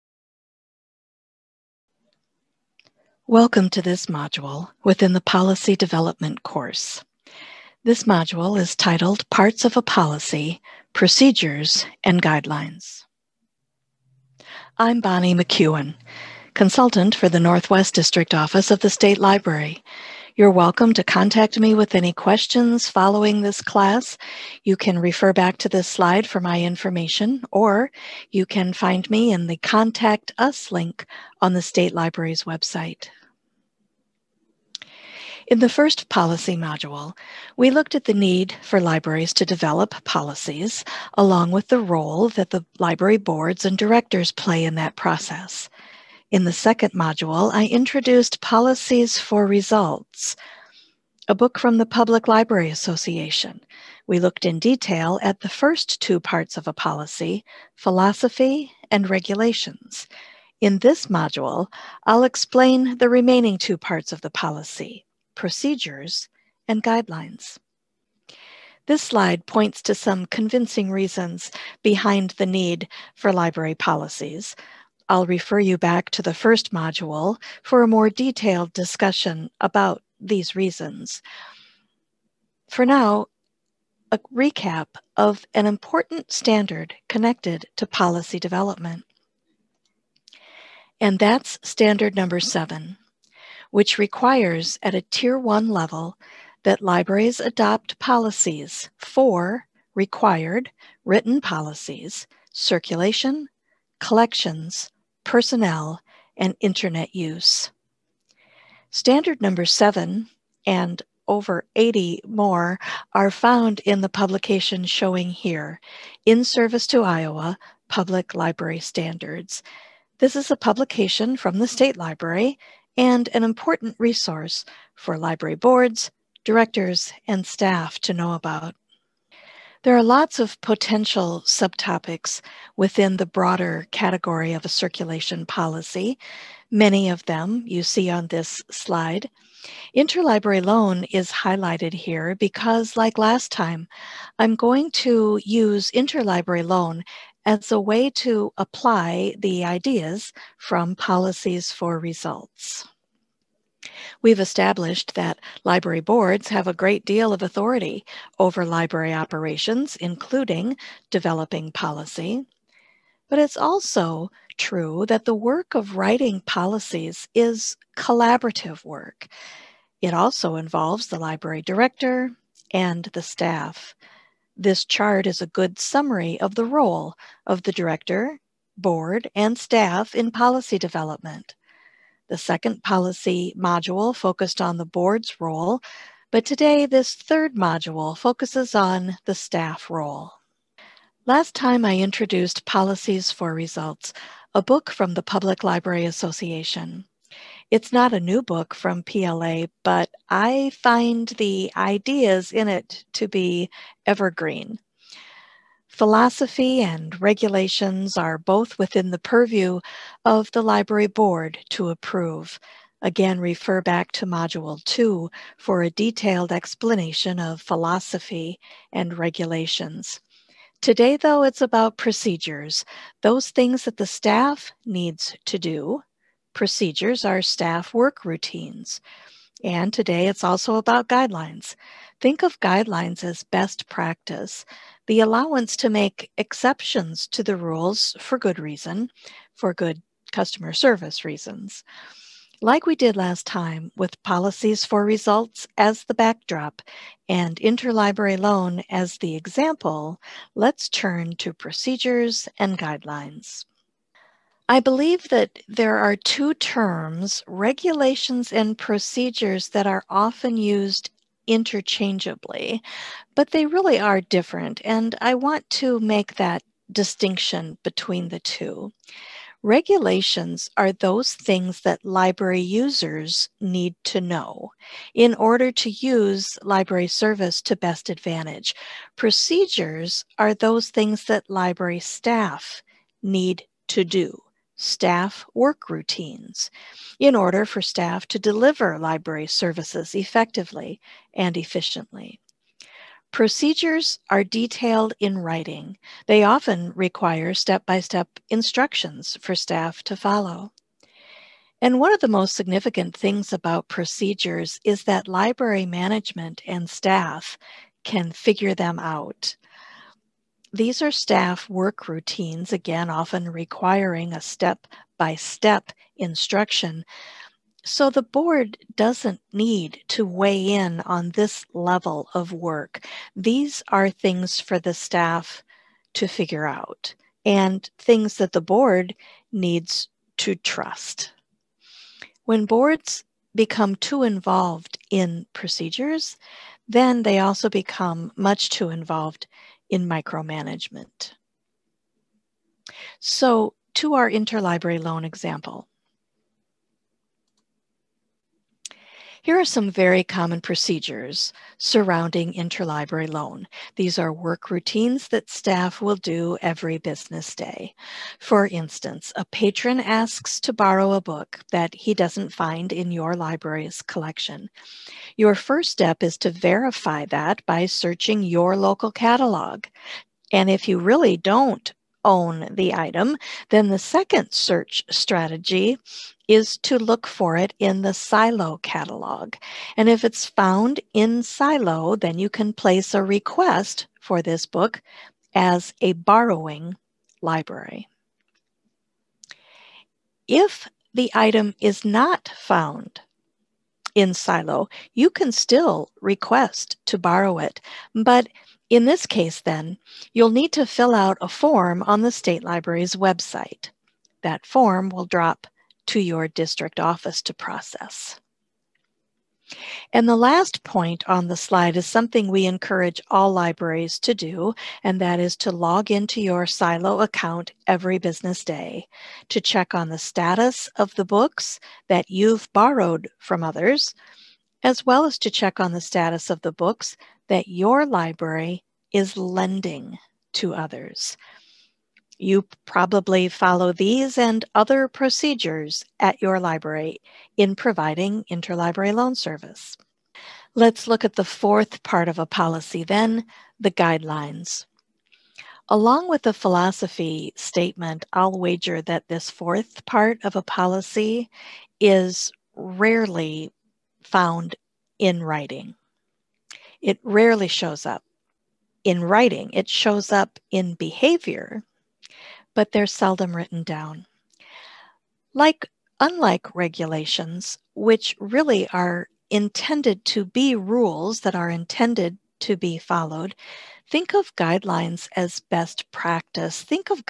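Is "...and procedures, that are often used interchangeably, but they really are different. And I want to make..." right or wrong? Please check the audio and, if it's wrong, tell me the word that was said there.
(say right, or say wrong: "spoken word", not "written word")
right.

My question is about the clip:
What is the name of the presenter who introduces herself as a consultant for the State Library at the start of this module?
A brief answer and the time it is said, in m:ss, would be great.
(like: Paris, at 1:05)
Bonnie McEwen, at 0:14.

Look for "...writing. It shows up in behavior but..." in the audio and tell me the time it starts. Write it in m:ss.
7:39.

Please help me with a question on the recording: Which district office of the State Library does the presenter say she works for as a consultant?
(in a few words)
Northwest.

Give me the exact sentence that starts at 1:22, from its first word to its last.
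For now, a recap of an important standard connected to policy development.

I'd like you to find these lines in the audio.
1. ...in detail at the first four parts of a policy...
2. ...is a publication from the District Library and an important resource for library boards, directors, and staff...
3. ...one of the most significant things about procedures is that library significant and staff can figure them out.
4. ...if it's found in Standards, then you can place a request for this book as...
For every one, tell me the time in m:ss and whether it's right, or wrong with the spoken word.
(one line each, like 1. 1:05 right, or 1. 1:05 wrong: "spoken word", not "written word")
1. 0:54 wrong: "two", not "four"
2. 2:00 wrong: "State", not "District"
3. 5:01 wrong: "management", not "significant"
4. 6:20 wrong: "SILO", not "Standards".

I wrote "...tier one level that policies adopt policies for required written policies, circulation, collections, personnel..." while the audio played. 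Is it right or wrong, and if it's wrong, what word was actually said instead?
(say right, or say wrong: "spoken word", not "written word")
wrong: "libraries", not "policies".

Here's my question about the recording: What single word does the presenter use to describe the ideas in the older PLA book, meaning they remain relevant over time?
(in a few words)
evergreen.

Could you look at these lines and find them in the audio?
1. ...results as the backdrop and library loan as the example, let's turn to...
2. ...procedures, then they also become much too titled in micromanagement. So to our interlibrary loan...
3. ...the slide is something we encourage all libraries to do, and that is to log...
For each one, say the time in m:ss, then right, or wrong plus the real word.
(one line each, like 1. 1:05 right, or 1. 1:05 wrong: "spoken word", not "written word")
1. 4:05 wrong: "interlibrary", not "library"
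2. 5:35 wrong: "involved", not "titled"
3. 6:51 right.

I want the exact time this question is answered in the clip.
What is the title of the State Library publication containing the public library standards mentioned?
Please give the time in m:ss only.
1:56.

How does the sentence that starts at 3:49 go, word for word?
And today, it's also about guidelines.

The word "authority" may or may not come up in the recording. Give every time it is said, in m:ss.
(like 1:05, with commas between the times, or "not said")
2:37.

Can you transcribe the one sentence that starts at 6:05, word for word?
Your first step is to verify that by searching your local catalog.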